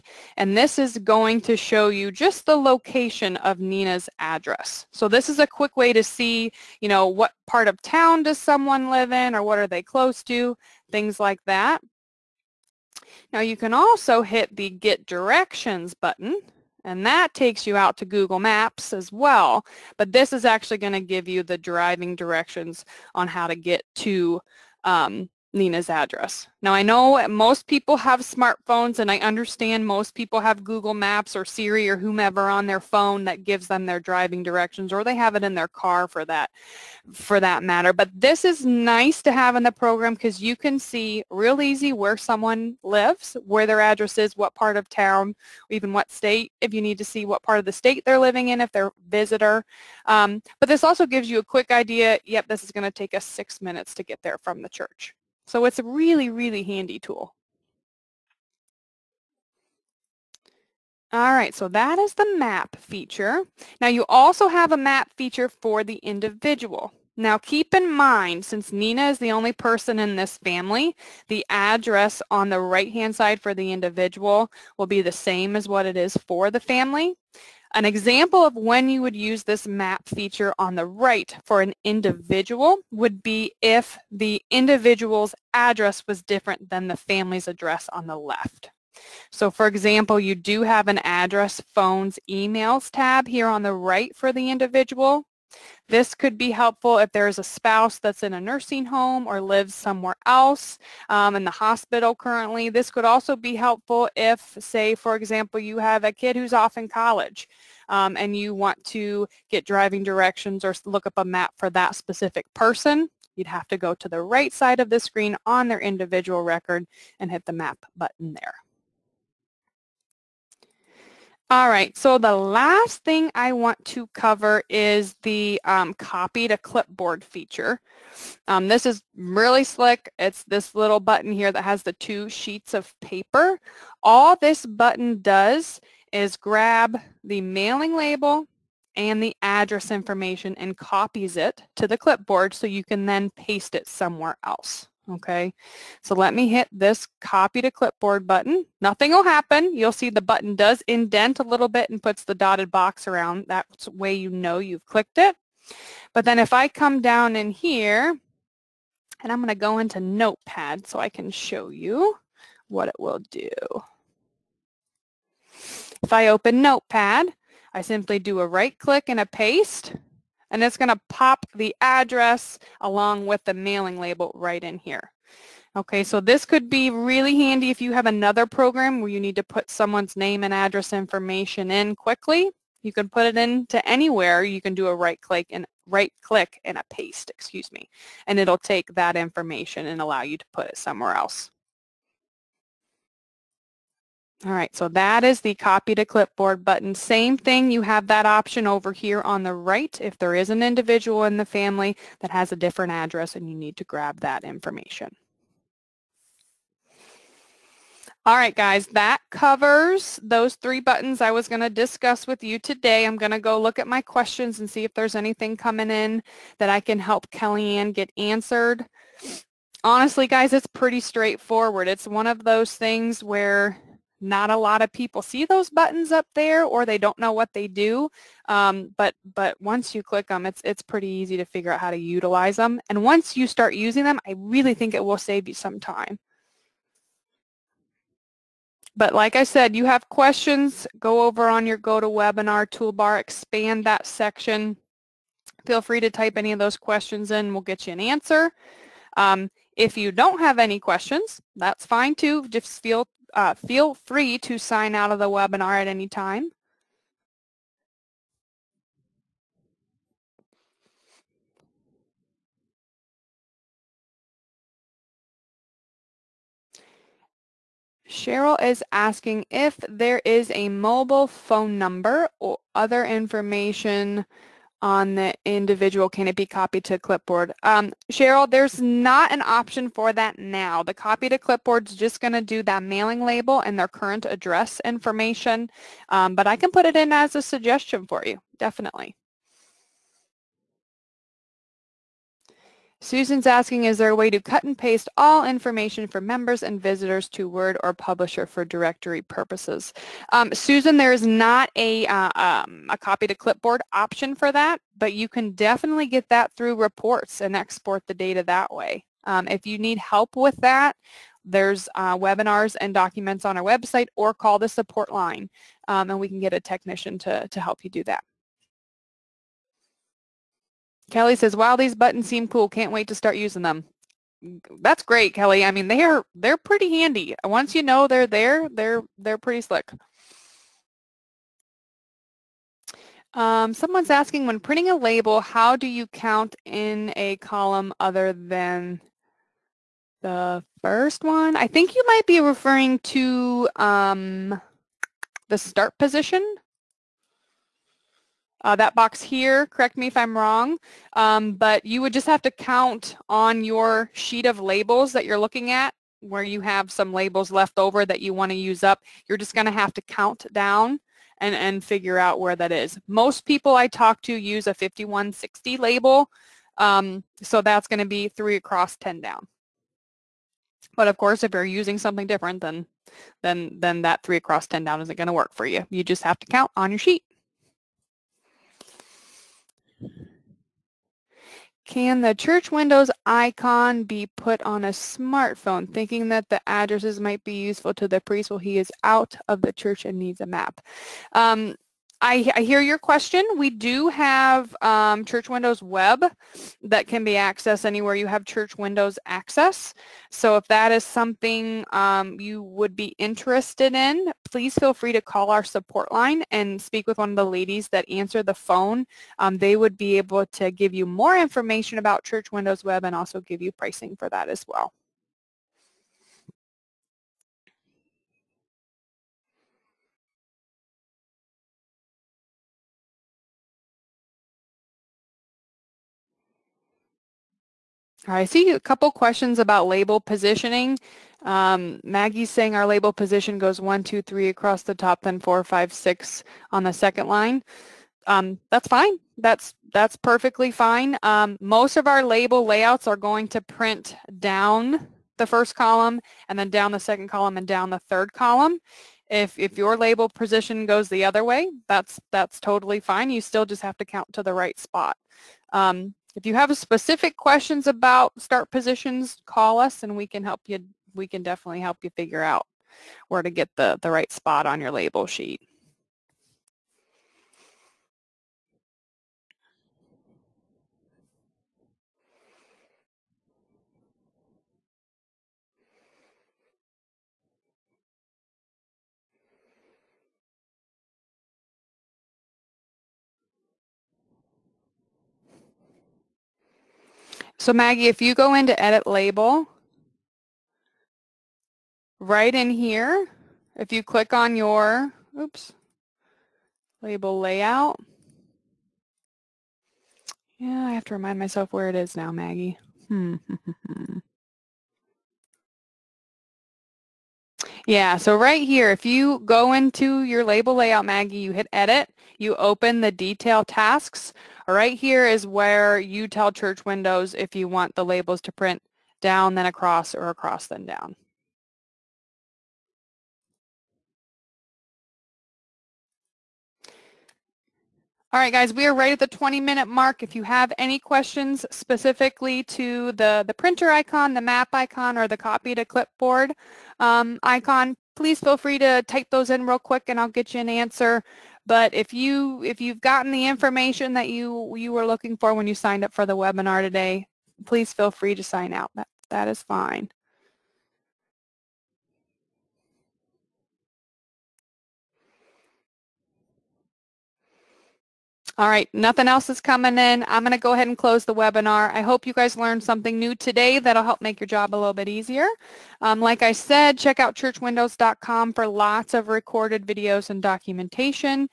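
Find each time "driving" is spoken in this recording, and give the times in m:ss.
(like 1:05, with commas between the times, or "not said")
0:21, 0:33, 1:49.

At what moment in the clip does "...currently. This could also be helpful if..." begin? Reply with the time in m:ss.
1:42.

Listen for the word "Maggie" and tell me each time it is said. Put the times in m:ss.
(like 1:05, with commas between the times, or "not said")
7:12, 8:07, 8:22, 8:31.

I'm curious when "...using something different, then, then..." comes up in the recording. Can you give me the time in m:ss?
6:11.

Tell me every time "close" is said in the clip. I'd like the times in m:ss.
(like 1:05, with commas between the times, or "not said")
0:09, 9:20.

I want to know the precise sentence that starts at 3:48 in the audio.
Um, but but once you click them, it's it's pretty easy to figure out how to utilize them.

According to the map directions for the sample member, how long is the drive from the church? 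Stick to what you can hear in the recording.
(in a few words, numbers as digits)
6 minutes.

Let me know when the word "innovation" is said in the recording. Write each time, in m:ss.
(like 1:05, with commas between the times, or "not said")
not said.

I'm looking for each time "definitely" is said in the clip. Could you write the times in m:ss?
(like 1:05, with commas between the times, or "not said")
4:48, 5:05, 7:41.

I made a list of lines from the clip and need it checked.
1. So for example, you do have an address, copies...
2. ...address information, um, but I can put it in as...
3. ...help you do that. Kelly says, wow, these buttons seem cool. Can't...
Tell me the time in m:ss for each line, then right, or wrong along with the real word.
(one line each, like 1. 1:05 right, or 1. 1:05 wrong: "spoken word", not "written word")
1. 1:29 wrong: "phones", not "copies"
2. 4:44 right
3. 5:17 right.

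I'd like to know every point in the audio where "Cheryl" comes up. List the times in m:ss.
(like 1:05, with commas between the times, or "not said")
4:28, 4:38.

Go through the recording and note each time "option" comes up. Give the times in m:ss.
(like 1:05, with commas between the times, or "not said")
3:18, 4:39, 5:03.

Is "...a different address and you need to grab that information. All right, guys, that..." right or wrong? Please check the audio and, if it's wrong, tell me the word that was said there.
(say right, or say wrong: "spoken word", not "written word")
right.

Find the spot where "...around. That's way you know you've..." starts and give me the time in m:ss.
2:33.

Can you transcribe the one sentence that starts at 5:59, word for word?
You're just going to have to count down and, and figure out where that is.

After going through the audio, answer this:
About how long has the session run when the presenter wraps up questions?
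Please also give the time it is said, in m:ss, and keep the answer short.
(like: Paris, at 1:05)
20 minutes, at 8:49.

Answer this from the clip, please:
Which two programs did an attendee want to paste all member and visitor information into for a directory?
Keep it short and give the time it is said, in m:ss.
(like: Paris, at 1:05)
Word or Publisher, at 4:57.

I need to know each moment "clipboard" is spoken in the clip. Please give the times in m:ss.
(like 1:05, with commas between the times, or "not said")
2:06, 2:21, 2:27, 3:16, 4:36, 4:41, 5:03, 8:55.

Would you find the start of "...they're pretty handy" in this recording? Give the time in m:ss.
5:26.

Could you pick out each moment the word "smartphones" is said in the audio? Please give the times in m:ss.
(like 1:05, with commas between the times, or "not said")
0:28, 6:24.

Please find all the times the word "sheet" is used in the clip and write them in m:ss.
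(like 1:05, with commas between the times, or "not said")
2:12, 5:54, 6:16, 7:45.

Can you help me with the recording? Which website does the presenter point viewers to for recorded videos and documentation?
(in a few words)
churchwindows.com.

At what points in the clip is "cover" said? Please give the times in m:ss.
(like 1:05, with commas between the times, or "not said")
2:04, 3:29.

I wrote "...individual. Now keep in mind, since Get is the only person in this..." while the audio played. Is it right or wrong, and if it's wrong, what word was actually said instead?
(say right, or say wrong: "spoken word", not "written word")
wrong: "Nina", not "Get".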